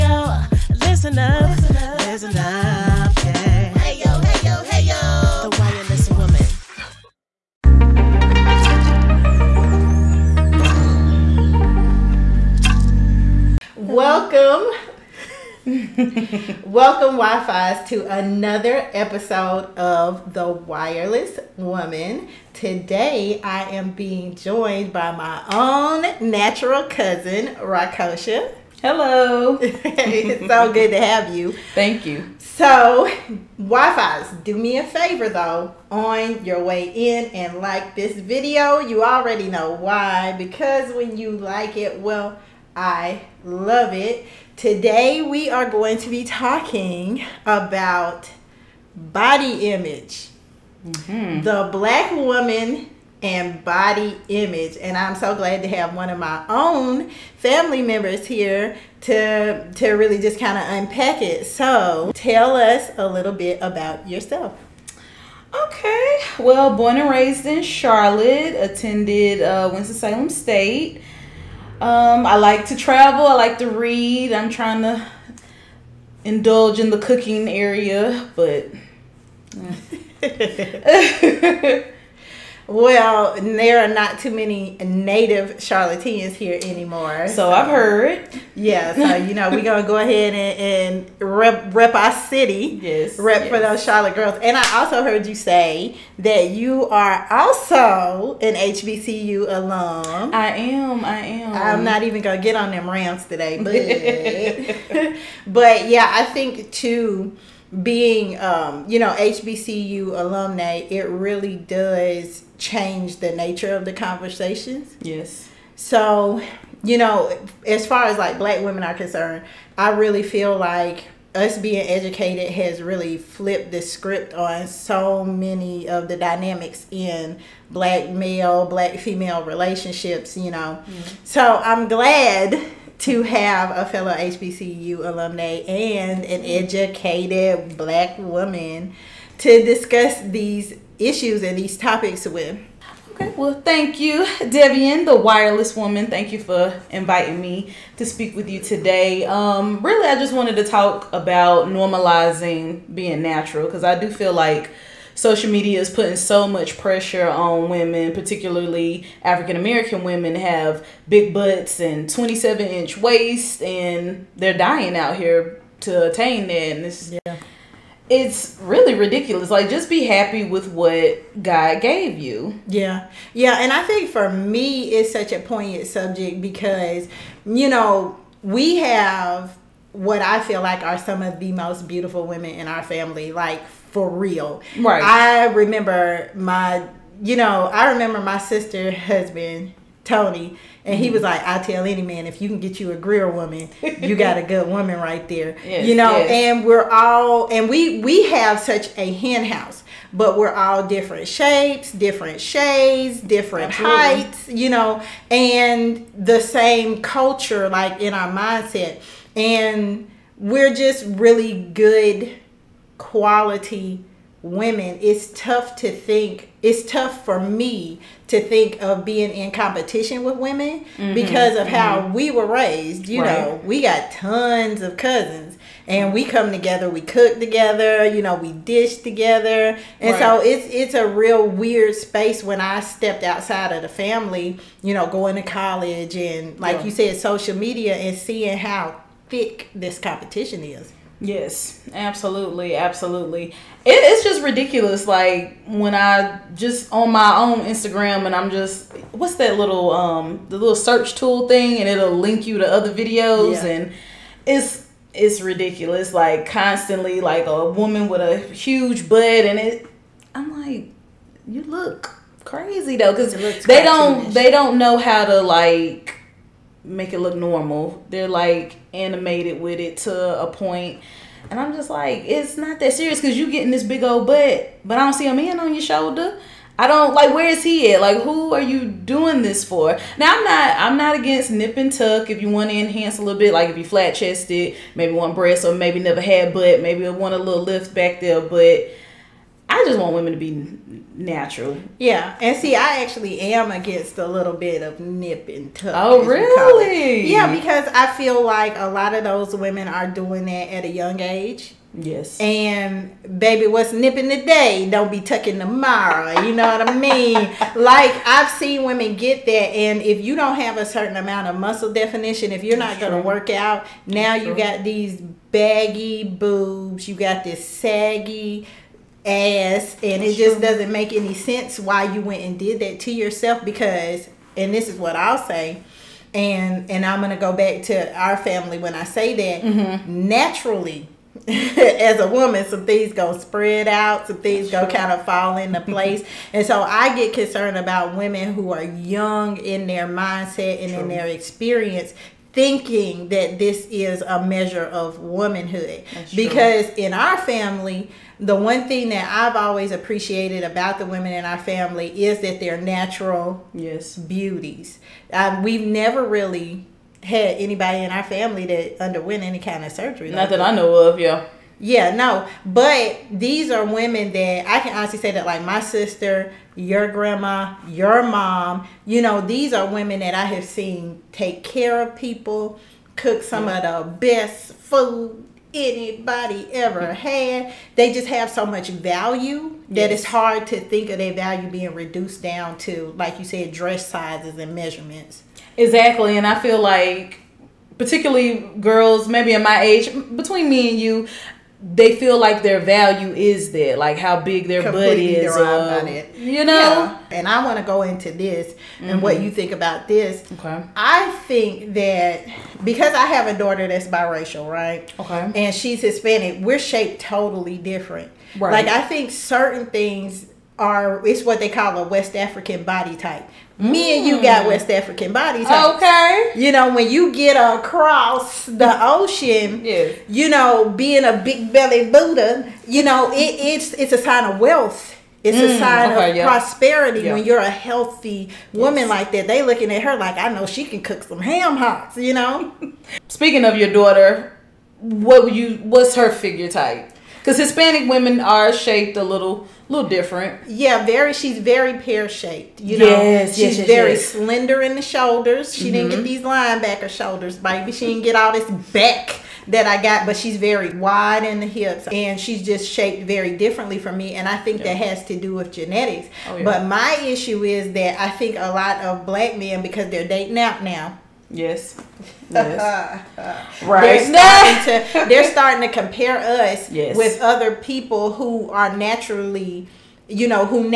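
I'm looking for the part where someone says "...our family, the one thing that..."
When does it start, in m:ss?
5:47.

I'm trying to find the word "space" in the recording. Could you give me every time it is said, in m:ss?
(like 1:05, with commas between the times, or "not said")
3:51.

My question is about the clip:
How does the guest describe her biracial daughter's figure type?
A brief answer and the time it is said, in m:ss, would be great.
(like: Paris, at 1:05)
Pear shaped, at 7:21.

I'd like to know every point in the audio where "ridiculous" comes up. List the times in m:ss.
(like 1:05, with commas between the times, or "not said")
2:48, 4:04, 4:15.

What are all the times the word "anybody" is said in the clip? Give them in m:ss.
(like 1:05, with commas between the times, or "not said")
5:57, 6:15.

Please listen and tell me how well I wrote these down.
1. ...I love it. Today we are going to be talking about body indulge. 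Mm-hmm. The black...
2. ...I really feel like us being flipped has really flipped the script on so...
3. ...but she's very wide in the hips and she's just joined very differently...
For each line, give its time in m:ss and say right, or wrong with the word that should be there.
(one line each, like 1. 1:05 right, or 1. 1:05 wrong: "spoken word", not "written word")
1. 0:42 wrong: "image", not "indulge"
2. 1:59 wrong: "educated", not "flipped"
3. 7:30 wrong: "shaped", not "joined".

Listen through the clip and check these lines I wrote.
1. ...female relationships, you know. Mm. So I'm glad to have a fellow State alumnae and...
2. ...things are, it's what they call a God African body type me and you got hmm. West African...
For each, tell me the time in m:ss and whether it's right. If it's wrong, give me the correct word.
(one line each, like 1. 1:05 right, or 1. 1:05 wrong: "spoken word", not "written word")
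1. 2:08 wrong: "HBCU", not "State"
2. 6:49 wrong: "West", not "God".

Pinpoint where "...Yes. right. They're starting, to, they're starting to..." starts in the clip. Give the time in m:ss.
7:42.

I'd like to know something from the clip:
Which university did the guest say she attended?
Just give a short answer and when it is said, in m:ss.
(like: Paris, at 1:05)
Winston Salem State, at 1:09.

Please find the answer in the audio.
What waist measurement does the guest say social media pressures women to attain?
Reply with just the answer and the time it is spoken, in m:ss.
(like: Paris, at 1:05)
27 inch, at 2:42.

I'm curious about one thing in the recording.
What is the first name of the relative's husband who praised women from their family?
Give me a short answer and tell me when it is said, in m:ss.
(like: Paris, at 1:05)
Tony, at 3:10.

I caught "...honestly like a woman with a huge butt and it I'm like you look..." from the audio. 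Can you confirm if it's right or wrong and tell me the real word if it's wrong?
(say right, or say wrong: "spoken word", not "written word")
wrong: "constantly", not "honestly".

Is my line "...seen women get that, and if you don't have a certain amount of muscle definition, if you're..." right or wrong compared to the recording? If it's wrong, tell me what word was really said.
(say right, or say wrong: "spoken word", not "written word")
right.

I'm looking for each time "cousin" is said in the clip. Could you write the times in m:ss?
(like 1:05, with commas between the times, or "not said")
0:26, 3:44.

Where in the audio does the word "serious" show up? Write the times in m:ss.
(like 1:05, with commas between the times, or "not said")
4:32.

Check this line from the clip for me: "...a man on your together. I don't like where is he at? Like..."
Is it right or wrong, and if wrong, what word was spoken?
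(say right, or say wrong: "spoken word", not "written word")
wrong: "shoulder", not "together".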